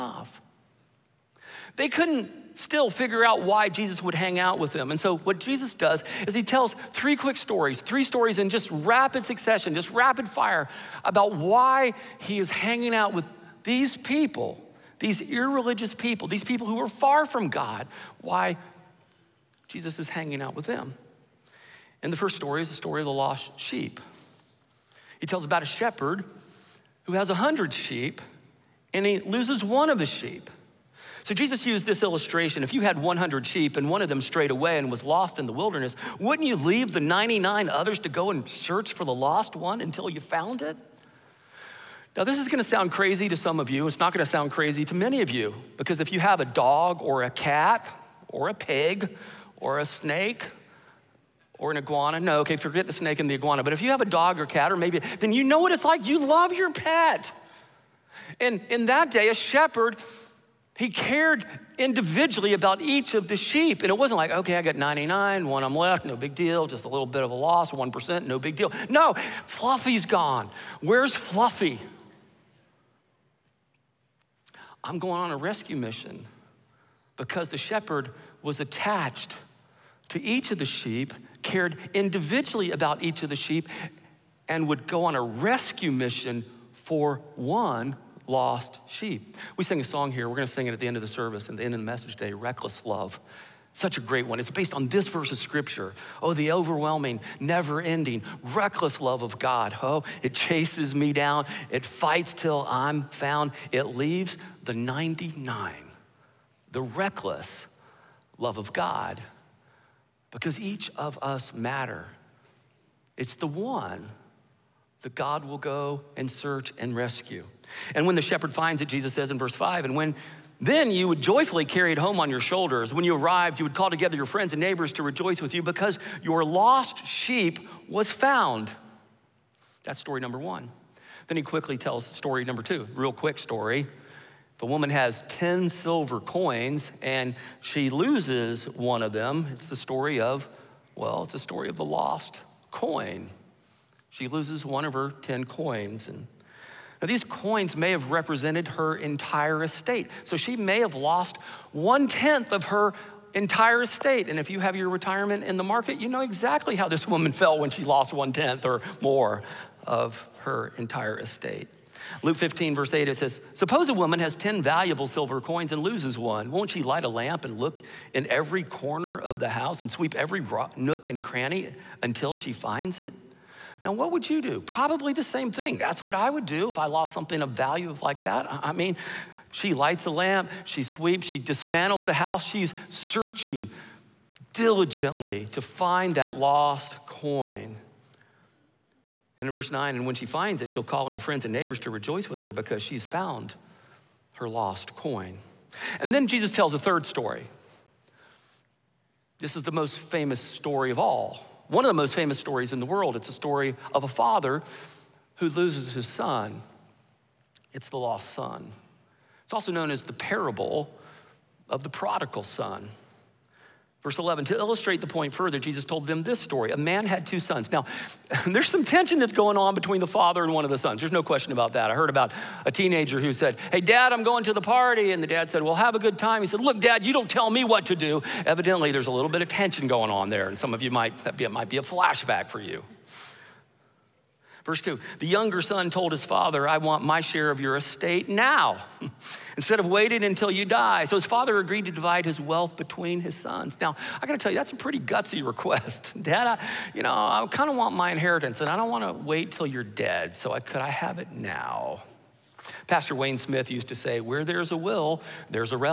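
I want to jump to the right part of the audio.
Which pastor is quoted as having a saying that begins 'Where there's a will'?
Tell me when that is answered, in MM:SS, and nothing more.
04:13.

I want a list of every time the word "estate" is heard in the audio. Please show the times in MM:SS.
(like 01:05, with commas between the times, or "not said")
02:29, 02:33, 02:41, 03:57.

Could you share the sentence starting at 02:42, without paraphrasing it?
Luke 15, verse 8, it says, Suppose a woman has 10 valuable silver coins and loses one.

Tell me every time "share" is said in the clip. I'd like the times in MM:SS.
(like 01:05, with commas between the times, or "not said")
03:57.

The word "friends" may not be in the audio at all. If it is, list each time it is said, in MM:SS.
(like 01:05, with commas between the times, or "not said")
02:04, 03:11.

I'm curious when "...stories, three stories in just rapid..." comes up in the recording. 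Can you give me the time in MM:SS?
00:07.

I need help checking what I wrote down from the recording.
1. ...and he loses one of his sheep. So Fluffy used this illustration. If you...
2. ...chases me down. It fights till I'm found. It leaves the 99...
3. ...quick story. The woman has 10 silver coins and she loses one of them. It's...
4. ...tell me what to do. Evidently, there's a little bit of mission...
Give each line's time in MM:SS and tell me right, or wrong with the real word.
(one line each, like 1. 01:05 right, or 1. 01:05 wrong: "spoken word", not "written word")
1. 00:28 wrong: "Jesus", not "Fluffy"
2. 01:40 right
3. 02:13 right
4. 03:47 wrong: "tension", not "mission".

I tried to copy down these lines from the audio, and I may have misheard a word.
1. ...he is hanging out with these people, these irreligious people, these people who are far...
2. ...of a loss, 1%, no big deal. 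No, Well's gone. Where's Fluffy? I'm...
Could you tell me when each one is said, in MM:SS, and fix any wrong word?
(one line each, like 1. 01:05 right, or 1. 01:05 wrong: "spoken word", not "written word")
1. 00:12 right
2. 01:07 wrong: "Fluffy", not "Well".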